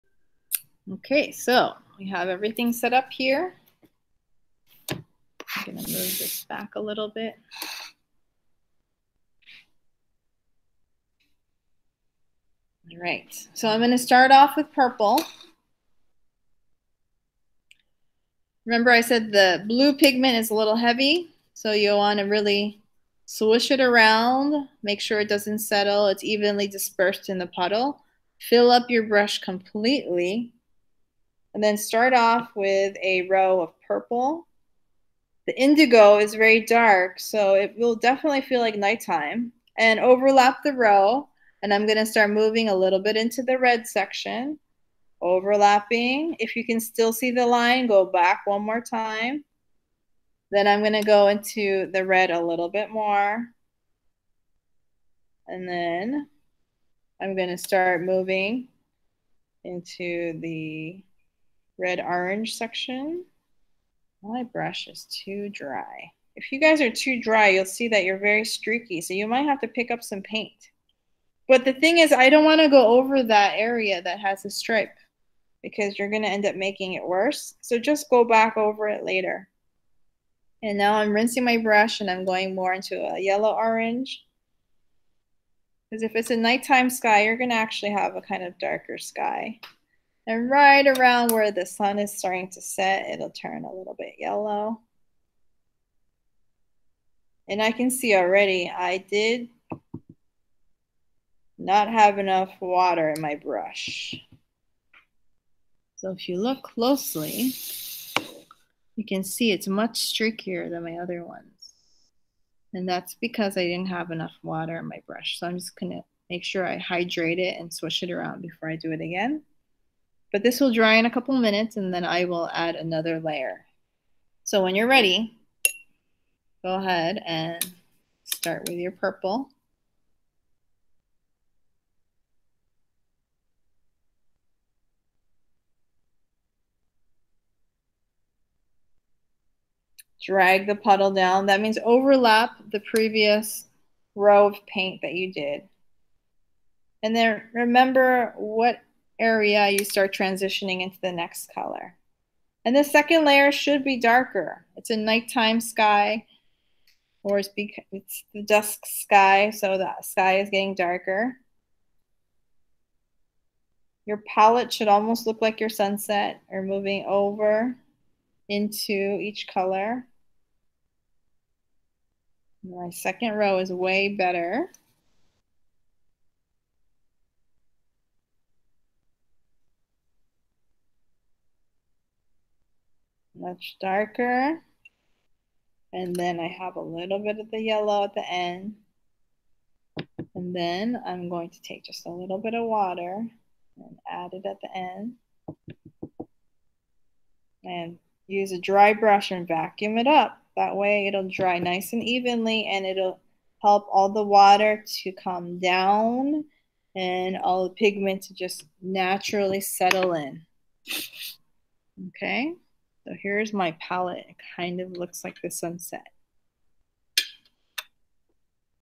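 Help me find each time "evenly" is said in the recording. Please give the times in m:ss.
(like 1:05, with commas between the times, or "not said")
0:26, 3:22.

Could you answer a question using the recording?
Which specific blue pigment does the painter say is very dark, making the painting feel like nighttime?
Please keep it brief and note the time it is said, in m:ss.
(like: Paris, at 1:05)
Indigo, at 0:35.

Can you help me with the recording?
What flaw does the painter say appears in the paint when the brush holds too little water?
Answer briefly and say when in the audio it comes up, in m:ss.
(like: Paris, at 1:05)
Streaky, at 1:08.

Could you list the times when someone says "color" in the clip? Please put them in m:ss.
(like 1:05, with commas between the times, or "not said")
2:31, 2:49.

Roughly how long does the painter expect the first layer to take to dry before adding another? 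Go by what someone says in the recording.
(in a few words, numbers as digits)
A couple minutes.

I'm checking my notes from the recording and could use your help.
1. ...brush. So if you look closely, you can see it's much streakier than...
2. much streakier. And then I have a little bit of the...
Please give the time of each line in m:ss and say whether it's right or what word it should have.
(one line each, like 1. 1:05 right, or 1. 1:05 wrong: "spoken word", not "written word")
1. 1:43 right
2. 3:03 wrong: "darker", not "streakier".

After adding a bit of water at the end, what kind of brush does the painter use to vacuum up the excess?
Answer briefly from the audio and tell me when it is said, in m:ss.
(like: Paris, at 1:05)
A dry brush, at 3:18.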